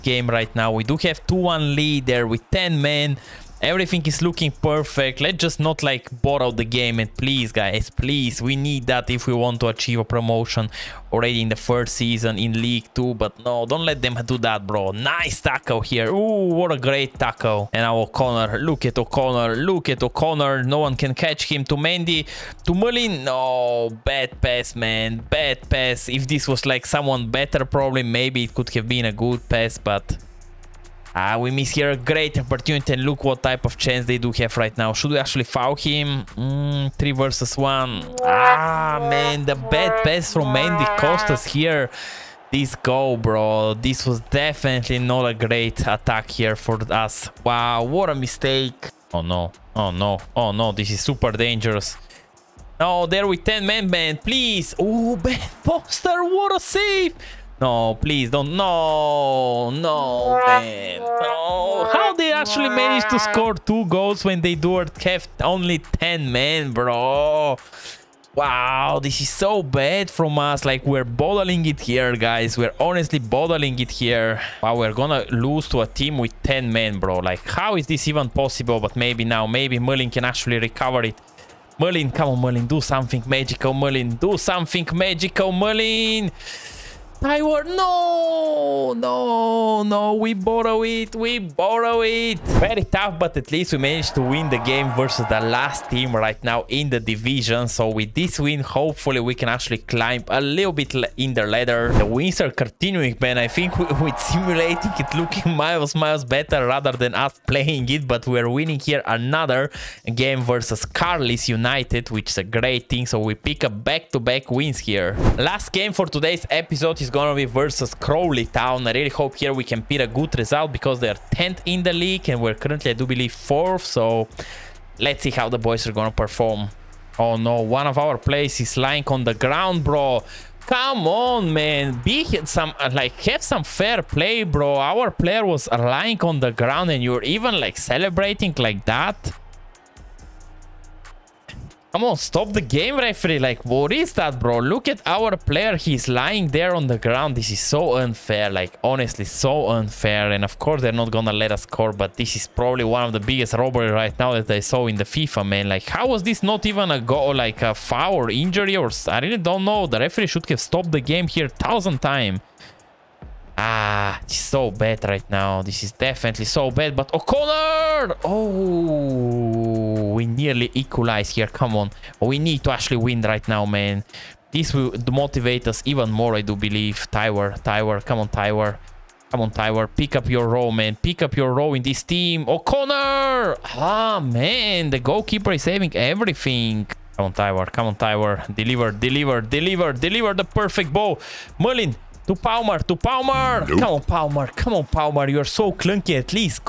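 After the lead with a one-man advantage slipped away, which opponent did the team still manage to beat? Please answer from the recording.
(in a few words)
Carlisle United.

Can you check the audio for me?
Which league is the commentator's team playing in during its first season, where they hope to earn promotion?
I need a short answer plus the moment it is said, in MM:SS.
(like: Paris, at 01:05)
League 2, at 00:12.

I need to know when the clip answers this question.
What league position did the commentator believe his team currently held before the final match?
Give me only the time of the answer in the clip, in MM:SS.
02:03.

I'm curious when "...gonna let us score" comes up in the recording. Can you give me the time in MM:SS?
02:31.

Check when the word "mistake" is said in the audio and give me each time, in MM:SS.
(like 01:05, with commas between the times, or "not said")
00:48.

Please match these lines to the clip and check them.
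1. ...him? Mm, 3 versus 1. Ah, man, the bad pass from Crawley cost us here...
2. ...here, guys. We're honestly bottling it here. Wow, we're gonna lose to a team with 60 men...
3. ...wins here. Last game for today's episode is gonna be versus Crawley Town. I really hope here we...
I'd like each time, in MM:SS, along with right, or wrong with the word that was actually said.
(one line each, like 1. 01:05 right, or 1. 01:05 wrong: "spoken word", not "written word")
1. 00:35 wrong: "Mendy", not "Crawley"
2. 01:11 wrong: "10", not "60"
3. 01:54 right.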